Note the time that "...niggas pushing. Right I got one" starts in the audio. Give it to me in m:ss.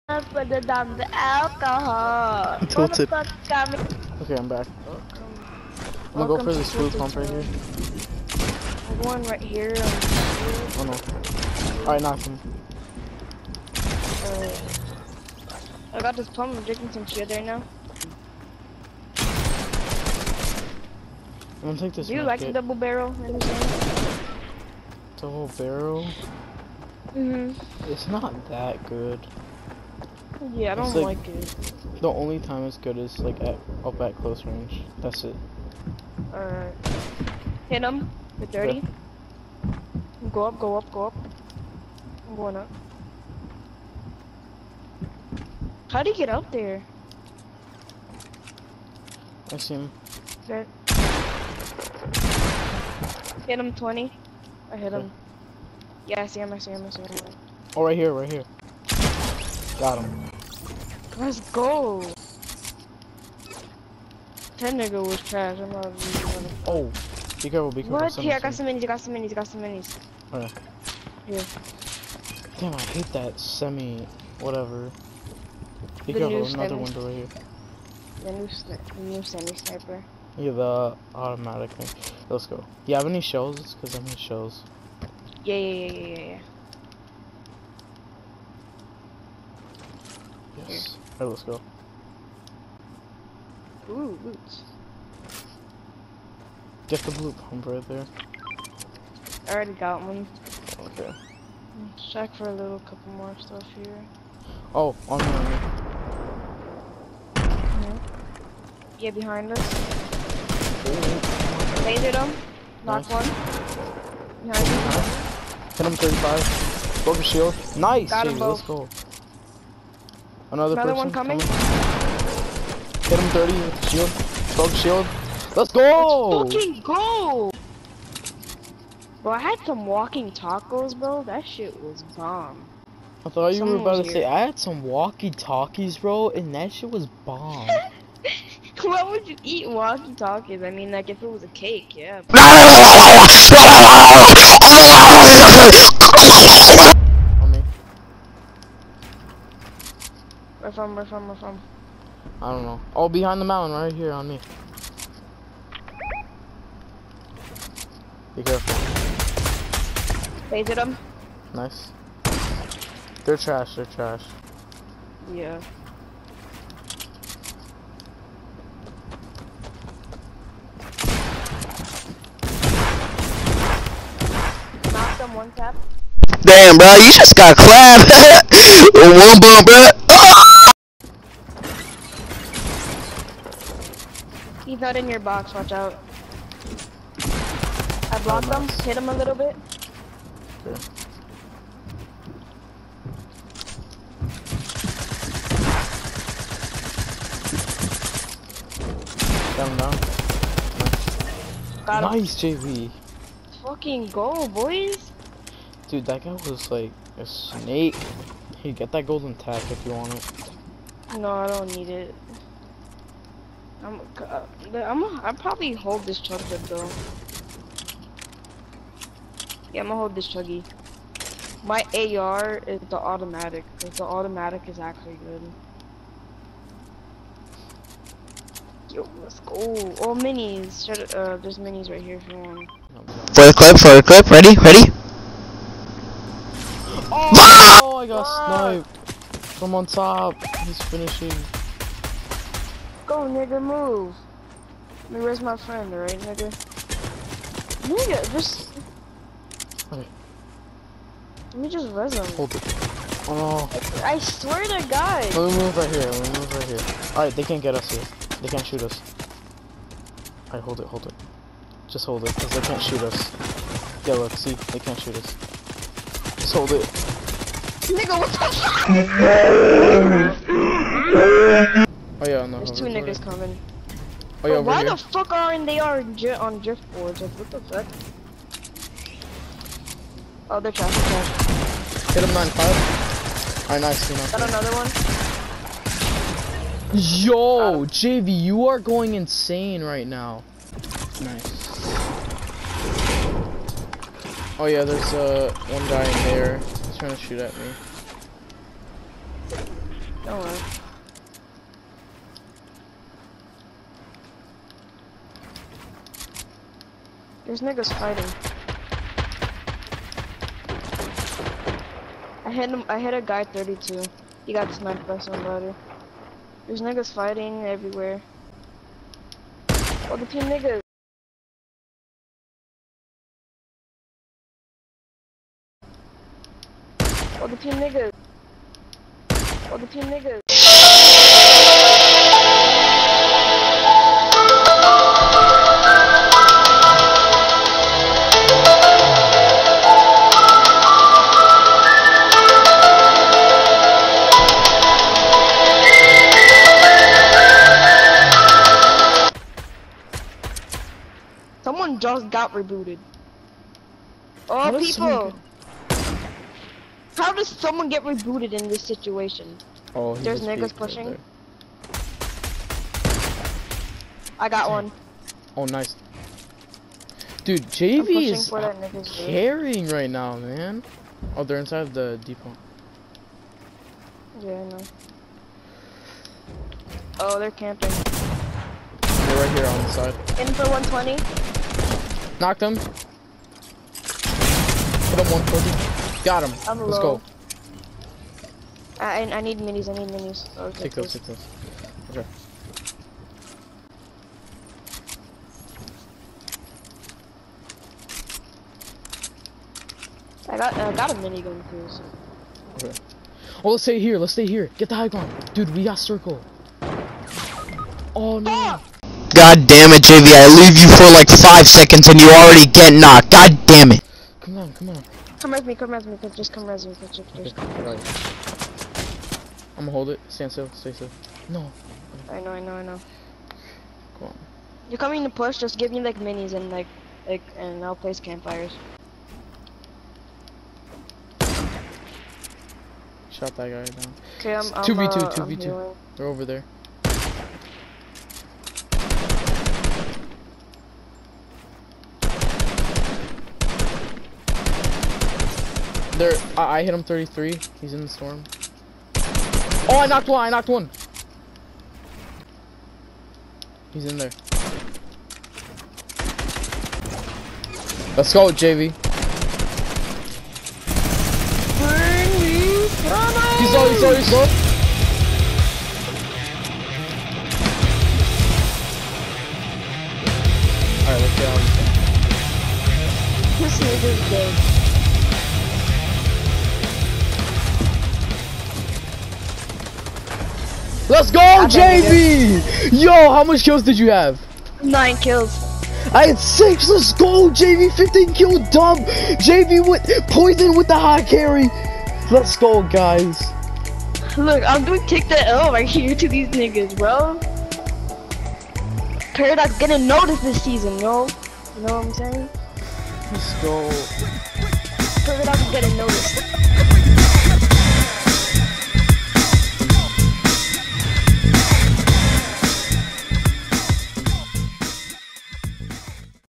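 6:00.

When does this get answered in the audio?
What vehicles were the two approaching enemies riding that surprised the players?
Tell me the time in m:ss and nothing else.
4:36.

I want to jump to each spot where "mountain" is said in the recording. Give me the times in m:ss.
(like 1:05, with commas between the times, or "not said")
2:33.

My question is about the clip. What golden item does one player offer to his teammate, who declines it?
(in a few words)
golden tack.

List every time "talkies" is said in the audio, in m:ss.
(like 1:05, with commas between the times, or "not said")
2:14, 2:19.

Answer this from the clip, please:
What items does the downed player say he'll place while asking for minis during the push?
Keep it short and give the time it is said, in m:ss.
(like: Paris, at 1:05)
campfires, at 7:08.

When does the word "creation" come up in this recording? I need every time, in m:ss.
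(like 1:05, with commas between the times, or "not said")
not said.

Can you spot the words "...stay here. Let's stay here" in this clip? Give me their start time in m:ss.
6:43.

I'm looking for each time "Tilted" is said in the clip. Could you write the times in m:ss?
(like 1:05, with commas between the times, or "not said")
0:02.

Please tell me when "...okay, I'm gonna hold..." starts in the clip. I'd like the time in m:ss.
6:57.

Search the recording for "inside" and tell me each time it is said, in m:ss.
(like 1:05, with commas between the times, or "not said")
6:11.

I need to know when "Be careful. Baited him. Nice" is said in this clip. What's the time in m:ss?
2:38.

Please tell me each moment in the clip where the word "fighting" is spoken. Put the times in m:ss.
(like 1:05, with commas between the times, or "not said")
5:07, 5:17.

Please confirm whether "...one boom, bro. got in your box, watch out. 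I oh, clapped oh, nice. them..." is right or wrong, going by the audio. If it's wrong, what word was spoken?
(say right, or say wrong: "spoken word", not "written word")
wrong: "blocked", not "clapped".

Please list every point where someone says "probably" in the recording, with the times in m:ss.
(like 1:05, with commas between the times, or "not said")
3:35.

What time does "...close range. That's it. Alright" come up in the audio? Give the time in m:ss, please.
0:34.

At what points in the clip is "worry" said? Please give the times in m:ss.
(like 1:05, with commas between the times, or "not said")
5:00.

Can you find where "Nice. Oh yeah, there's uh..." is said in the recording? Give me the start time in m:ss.
4:51.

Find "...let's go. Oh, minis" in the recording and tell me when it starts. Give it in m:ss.
3:49.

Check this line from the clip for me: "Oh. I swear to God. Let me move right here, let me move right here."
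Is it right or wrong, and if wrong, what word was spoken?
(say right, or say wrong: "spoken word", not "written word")
right.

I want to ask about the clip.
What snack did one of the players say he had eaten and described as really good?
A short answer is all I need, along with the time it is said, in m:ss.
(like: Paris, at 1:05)
walking tacos, at 2:09.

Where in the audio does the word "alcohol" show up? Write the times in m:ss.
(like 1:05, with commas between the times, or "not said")
0:01.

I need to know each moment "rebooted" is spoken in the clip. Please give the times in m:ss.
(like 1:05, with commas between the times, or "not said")
5:52, 5:58.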